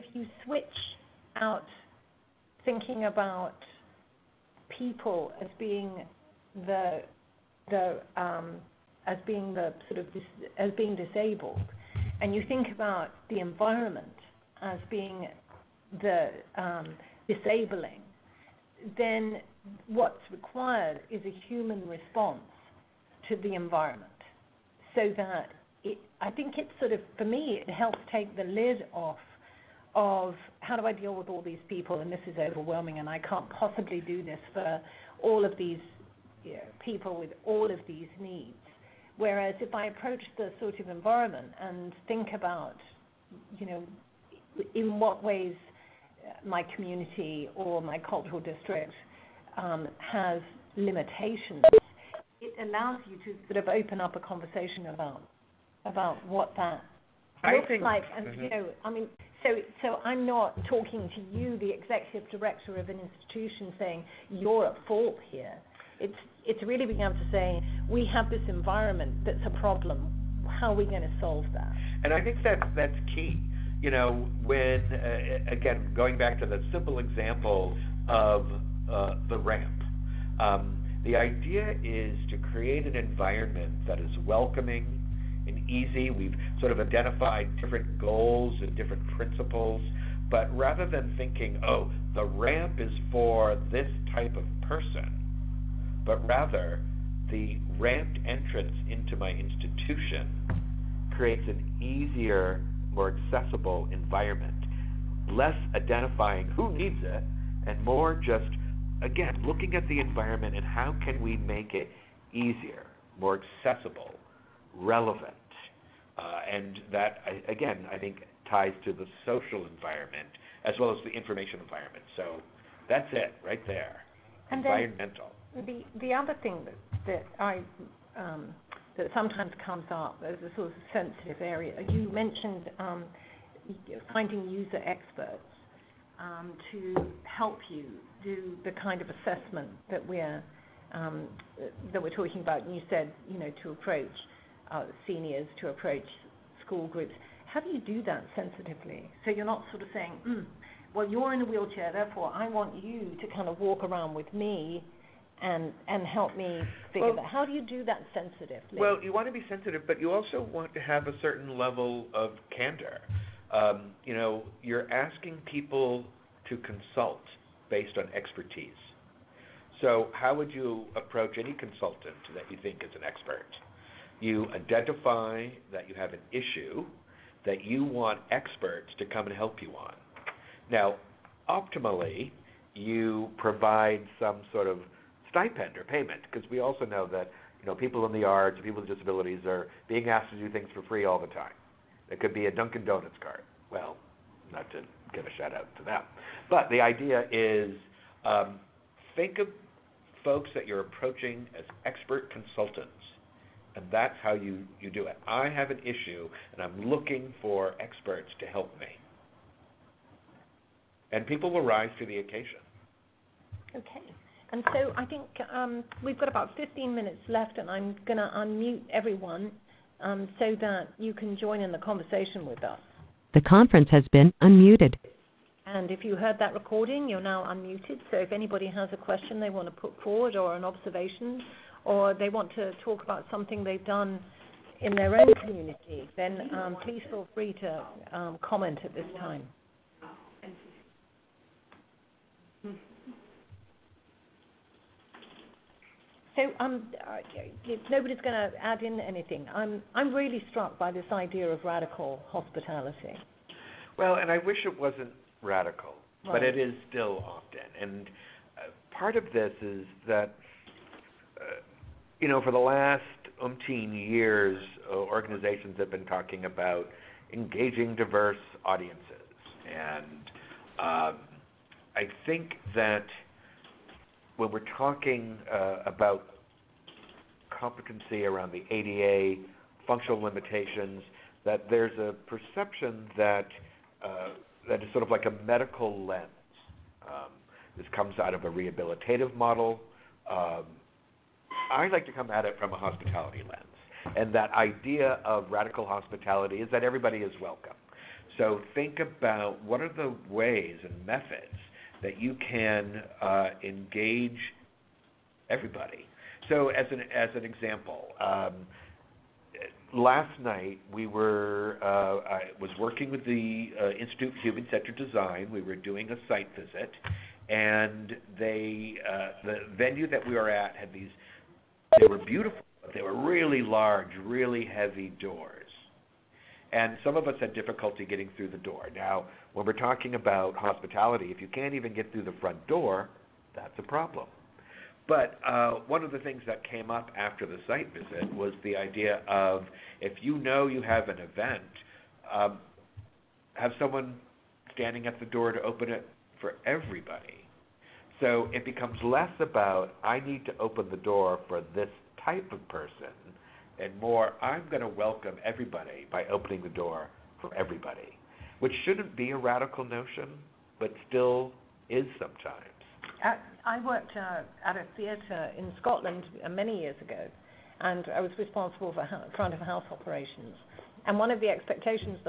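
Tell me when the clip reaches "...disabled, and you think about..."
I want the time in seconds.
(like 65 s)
10 s.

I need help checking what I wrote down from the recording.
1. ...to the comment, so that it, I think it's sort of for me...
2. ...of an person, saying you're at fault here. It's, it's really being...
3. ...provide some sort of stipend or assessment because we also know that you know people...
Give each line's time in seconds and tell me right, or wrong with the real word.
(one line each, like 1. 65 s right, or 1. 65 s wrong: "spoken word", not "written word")
1. 23 s wrong: "environment", not "comment"
2. 62 s wrong: "institution", not "person"
3. 183 s wrong: "payment", not "assessment".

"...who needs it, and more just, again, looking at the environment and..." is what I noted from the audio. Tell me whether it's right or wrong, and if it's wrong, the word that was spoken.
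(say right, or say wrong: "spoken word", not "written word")
right.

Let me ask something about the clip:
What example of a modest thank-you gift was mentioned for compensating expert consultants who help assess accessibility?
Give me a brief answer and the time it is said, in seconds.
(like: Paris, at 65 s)
Dunkin' Donuts card, at 192 s.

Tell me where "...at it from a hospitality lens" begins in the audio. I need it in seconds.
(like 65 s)
292 s.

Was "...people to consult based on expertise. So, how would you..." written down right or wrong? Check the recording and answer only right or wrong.
right.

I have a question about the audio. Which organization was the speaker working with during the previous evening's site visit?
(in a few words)
Institute for Human Centered Design.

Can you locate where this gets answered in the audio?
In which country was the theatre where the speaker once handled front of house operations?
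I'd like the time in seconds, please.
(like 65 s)
365 s.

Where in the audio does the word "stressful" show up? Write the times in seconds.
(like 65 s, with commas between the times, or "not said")
not said.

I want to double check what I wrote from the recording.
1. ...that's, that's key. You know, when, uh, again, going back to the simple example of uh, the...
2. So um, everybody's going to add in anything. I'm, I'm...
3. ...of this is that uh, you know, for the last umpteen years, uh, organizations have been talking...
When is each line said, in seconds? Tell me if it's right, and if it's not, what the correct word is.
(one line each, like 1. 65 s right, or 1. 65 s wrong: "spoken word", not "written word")
1. 72 s right
2. 246 s wrong: "nobody", not "everybody"
3. 259 s right.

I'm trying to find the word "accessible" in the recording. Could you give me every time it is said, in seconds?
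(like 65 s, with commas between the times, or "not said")
103 s, 113 s.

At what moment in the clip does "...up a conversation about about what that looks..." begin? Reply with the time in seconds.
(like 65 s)
53 s.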